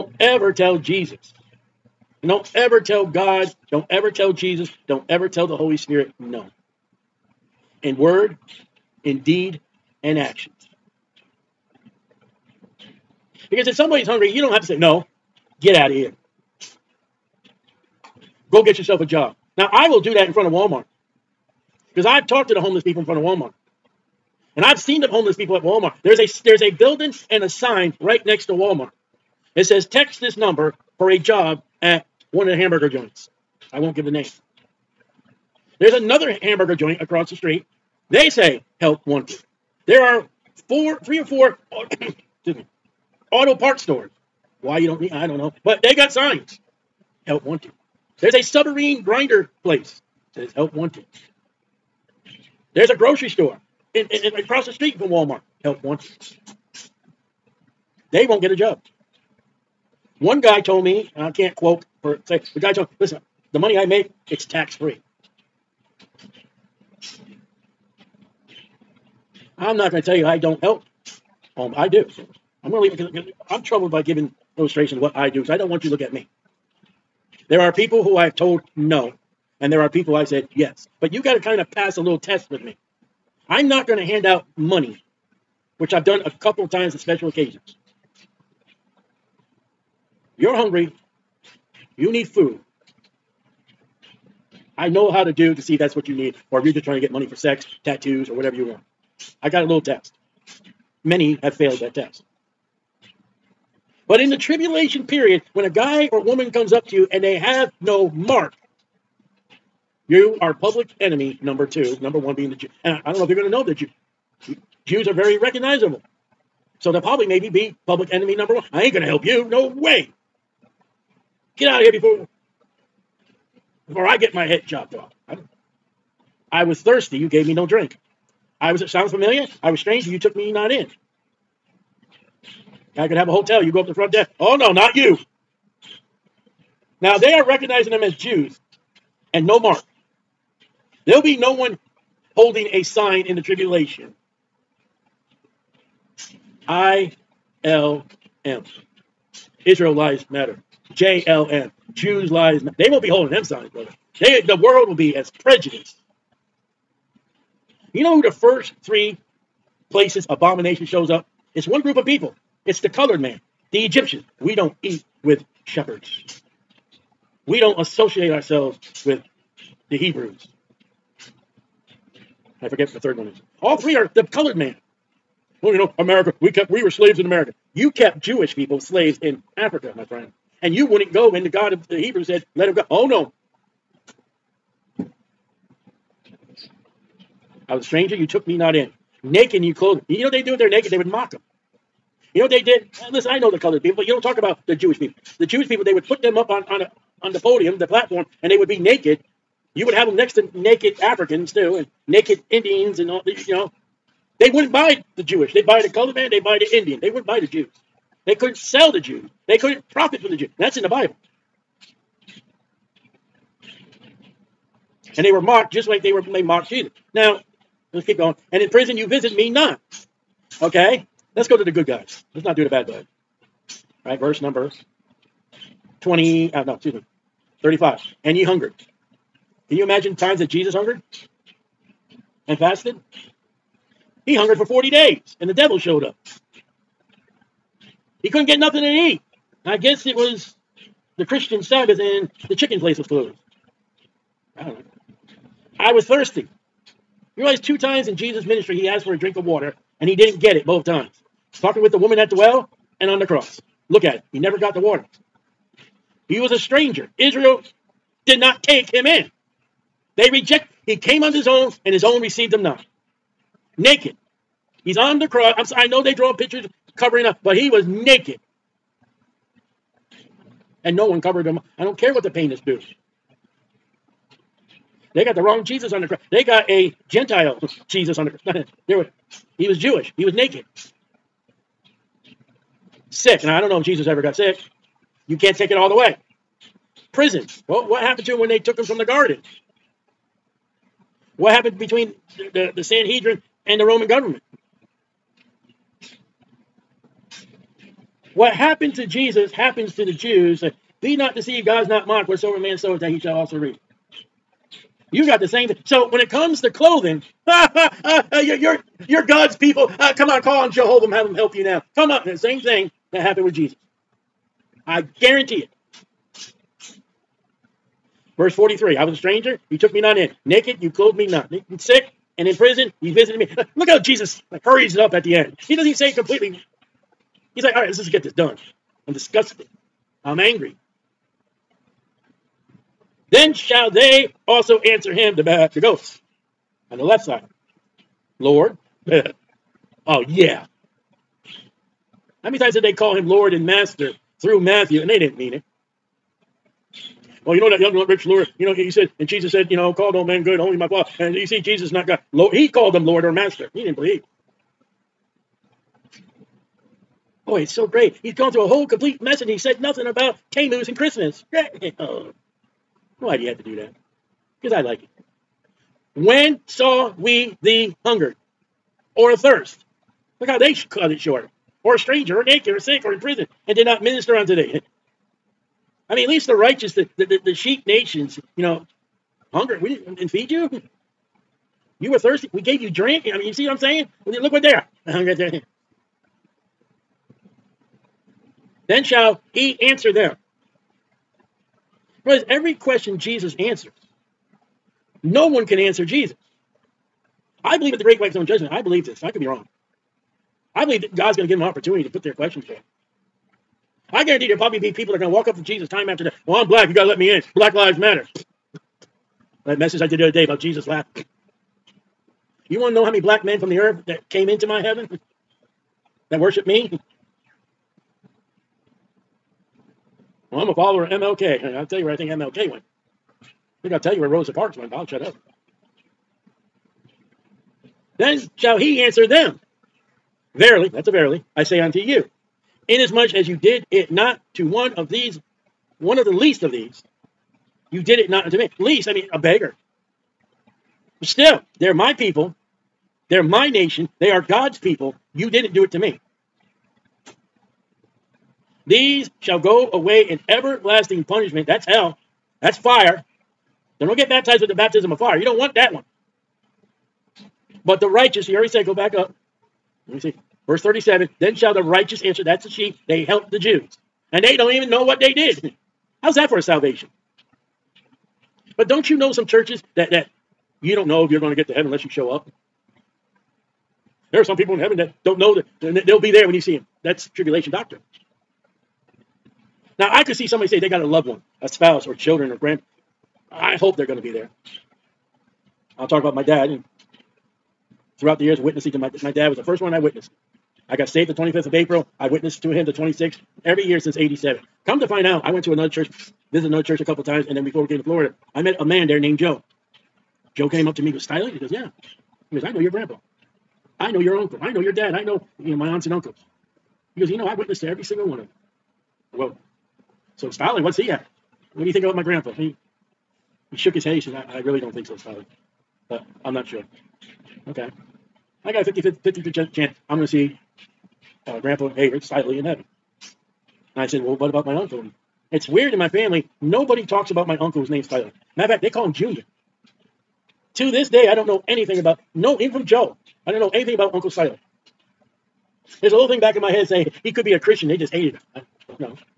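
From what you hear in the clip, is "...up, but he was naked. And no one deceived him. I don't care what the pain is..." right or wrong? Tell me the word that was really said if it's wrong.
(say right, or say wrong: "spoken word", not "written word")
wrong: "covered", not "deceived".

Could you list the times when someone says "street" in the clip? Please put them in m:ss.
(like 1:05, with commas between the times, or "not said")
0:37, 0:54.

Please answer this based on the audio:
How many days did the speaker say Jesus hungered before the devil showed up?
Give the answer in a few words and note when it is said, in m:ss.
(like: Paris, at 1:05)
40, at 3:54.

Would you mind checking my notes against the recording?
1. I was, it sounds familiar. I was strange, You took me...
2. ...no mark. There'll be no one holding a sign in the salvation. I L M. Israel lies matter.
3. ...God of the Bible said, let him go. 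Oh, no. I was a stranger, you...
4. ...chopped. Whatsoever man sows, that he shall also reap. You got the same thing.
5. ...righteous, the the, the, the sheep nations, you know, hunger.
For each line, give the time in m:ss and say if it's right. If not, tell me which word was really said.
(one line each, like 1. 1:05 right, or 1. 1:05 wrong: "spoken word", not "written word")
1. 2:08 right
2. 2:19 wrong: "tribulation", not "salvation"
3. 3:01 wrong: "Hebrews", not "Bible"
4. 5:02 wrong: "mocked", not "chopped"
5. 6:16 right.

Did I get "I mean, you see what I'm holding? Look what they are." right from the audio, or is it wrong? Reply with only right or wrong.
wrong.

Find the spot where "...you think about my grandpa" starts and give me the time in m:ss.
8:31.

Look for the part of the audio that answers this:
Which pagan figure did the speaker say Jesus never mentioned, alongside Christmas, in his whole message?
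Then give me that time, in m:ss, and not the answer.
6:00.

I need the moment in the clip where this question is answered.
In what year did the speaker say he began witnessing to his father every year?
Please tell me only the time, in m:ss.
8:14.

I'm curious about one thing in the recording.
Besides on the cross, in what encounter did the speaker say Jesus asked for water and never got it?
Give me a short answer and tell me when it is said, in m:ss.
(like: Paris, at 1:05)
the woman at the well, at 4:11.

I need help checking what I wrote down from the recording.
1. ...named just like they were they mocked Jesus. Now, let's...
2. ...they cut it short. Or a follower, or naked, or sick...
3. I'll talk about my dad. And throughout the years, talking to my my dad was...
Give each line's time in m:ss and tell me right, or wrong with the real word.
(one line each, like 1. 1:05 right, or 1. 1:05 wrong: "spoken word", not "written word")
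1. 3:35 wrong: "mocked", not "named"
2. 6:10 wrong: "stranger", not "follower"
3. 8:05 wrong: "witnessing", not "talking".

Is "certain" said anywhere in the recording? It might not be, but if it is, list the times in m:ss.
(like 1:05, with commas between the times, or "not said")
not said.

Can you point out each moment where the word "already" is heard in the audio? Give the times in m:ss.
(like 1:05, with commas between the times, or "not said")
7:38.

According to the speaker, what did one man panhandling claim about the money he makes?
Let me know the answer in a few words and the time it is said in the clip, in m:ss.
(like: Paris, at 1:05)
tax free, at 1:04.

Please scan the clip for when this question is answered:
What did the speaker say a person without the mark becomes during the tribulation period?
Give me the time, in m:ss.
1:50.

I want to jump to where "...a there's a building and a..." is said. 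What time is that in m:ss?
0:26.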